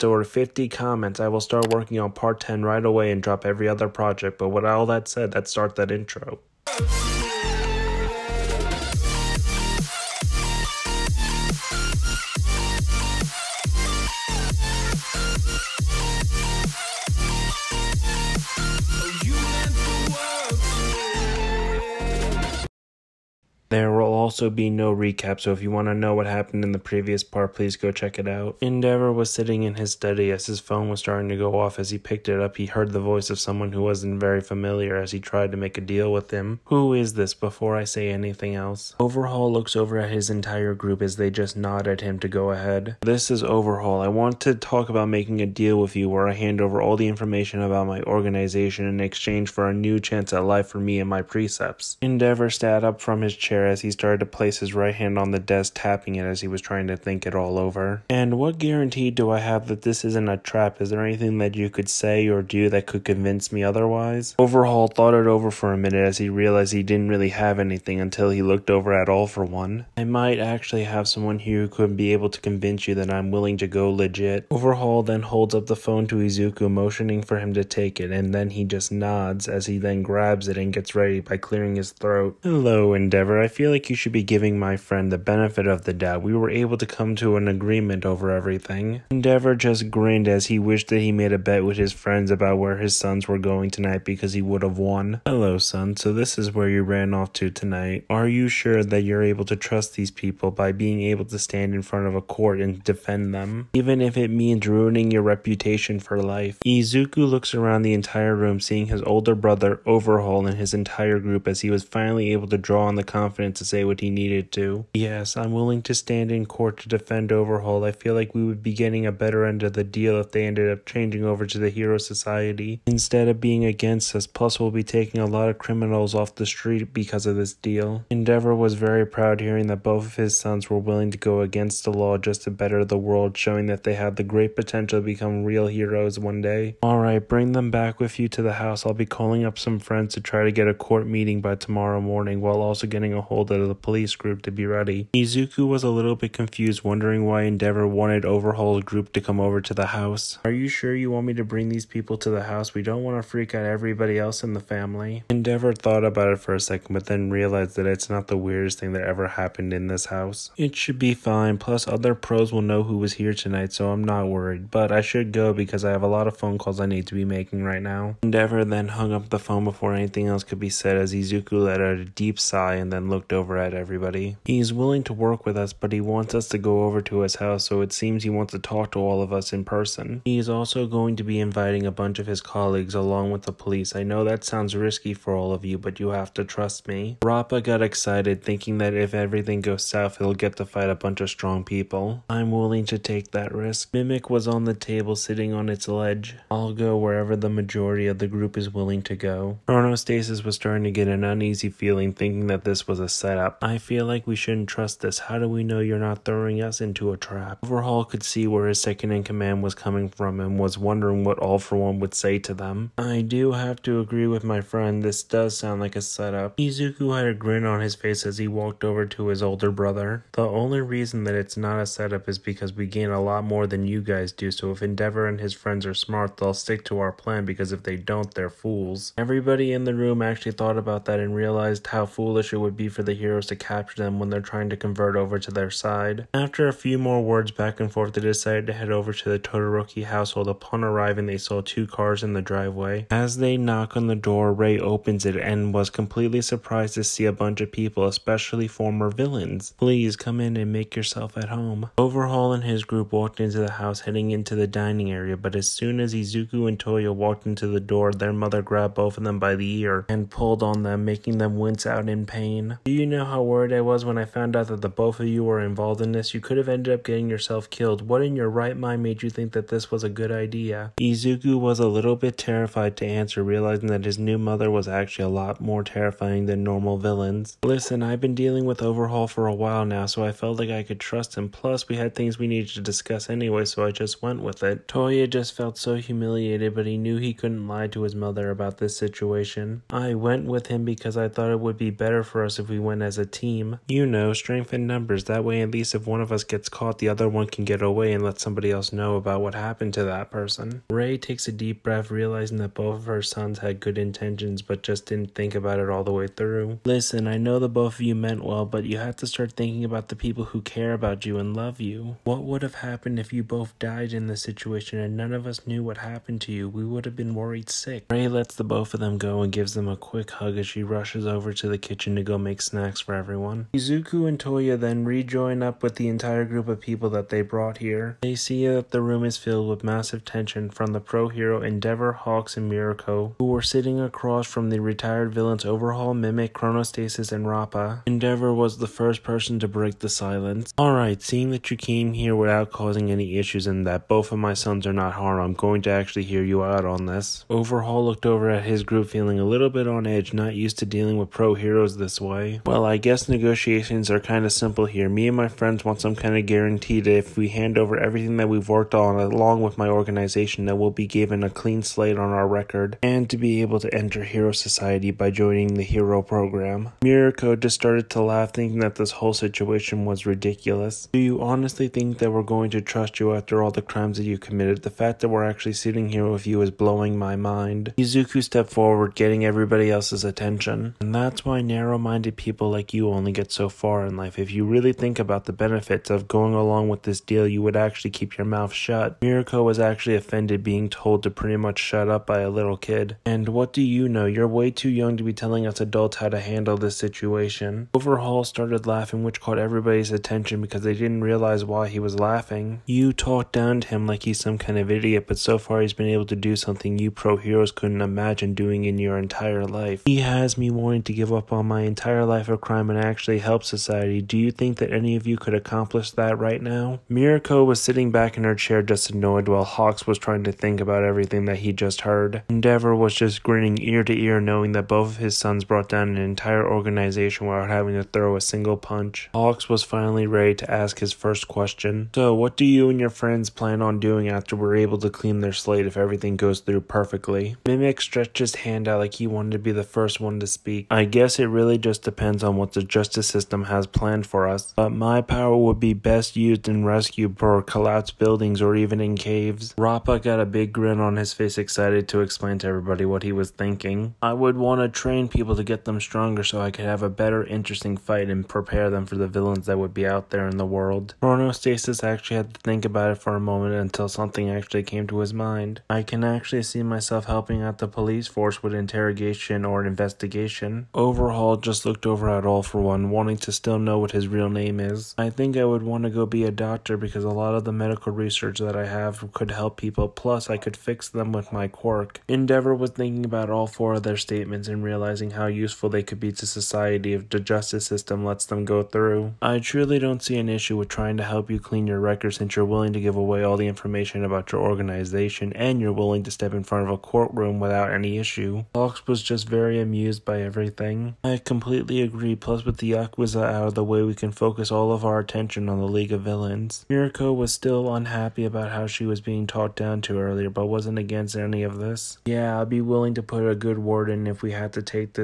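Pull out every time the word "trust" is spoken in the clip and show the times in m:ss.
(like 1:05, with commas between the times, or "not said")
1:39, 3:06, 3:24, 4:40, 6:12.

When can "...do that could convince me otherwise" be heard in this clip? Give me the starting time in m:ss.
1:02.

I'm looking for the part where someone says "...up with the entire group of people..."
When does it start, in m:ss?
5:25.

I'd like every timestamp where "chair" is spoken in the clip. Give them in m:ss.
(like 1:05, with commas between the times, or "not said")
0:53, 6:58.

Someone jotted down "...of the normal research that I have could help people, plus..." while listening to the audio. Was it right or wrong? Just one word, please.
wrong.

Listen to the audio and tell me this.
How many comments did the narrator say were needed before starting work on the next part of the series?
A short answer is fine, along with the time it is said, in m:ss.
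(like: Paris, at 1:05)
50, at 0:00.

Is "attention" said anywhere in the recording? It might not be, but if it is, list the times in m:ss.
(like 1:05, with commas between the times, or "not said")
6:20, 6:40, 8:25.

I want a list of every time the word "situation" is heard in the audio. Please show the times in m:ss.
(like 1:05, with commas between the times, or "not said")
4:48, 5:14, 6:09, 6:36.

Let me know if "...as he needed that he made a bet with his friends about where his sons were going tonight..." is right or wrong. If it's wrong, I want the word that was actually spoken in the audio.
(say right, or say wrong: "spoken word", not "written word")
wrong: "wished", not "needed".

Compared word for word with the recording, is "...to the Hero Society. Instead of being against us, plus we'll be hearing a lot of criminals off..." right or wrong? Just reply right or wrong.
wrong.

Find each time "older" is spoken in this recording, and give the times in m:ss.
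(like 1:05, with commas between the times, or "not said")
1:49, 3:39.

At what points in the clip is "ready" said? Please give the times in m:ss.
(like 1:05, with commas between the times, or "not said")
1:20, 2:24, 7:10.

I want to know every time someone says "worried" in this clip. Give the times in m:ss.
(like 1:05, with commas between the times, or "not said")
2:44, 4:23, 5:17.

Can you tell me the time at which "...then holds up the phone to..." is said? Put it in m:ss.
1:15.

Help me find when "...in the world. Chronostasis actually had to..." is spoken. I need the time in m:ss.
7:40.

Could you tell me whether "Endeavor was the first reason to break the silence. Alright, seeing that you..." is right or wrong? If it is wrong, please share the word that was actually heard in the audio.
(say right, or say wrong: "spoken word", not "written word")
wrong: "person", not "reason".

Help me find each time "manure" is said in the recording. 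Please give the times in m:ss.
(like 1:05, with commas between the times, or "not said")
not said.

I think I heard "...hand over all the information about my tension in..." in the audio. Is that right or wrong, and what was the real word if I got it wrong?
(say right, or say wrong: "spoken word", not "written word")
wrong: "organization", not "tension".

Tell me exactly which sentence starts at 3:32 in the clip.
I do have to agree with my friend, this does sound like a setup.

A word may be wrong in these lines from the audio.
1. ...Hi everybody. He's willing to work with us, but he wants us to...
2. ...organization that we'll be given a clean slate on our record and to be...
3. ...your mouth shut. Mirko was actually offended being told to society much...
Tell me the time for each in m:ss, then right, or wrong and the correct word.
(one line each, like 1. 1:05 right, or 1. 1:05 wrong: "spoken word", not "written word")
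1. 2:53 right
2. 5:59 right
3. 6:28 wrong: "pretty", not "society".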